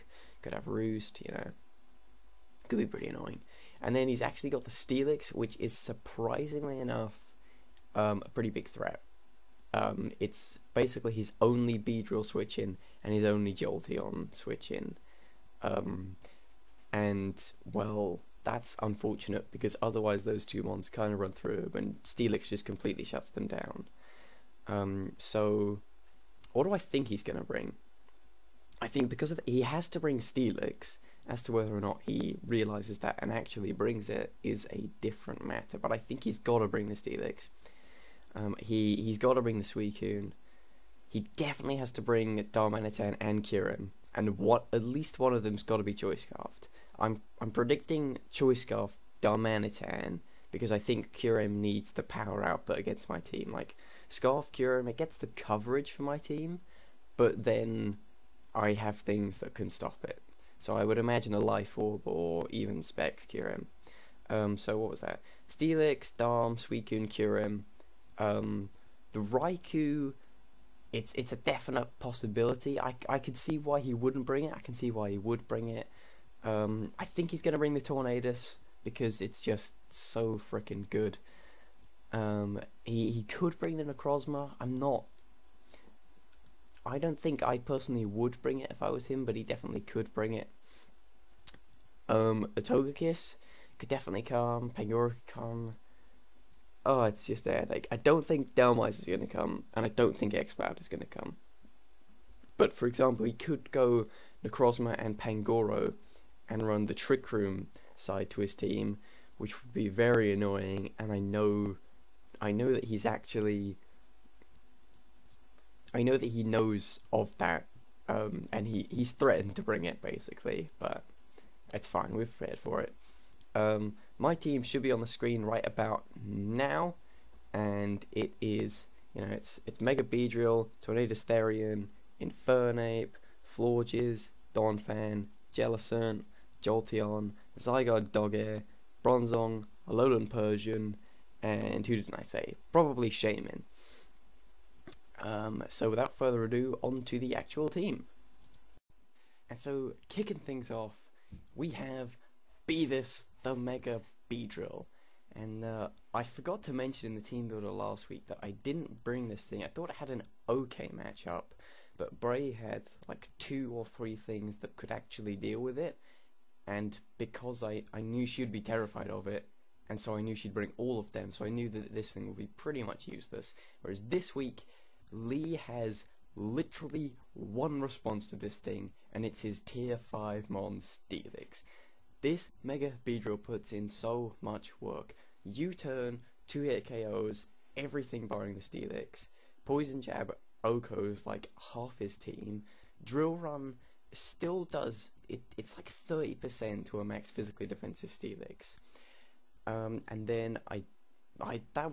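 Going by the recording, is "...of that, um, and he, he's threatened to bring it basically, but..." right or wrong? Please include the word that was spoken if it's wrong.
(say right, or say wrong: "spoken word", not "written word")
right.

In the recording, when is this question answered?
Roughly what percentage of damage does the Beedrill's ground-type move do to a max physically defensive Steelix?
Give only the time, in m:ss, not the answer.
3:15.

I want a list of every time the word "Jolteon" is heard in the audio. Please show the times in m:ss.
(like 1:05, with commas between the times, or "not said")
0:13, 2:16.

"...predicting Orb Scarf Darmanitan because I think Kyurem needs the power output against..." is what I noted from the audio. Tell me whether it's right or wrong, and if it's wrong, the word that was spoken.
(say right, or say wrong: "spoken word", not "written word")
wrong: "Choice", not "Orb".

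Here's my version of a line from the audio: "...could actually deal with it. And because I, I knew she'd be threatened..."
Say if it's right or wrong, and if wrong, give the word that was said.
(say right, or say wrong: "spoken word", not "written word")
wrong: "terrified", not "threatened".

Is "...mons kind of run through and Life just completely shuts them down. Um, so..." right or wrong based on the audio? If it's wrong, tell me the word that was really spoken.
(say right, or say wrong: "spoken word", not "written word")
wrong: "Steelix", not "Life".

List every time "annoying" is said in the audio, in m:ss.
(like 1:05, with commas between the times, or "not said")
0:03, 1:50.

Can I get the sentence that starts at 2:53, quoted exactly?
Whereas this week, Lee has literally one response to this thing, and it's his tier 5 Mon Steelix.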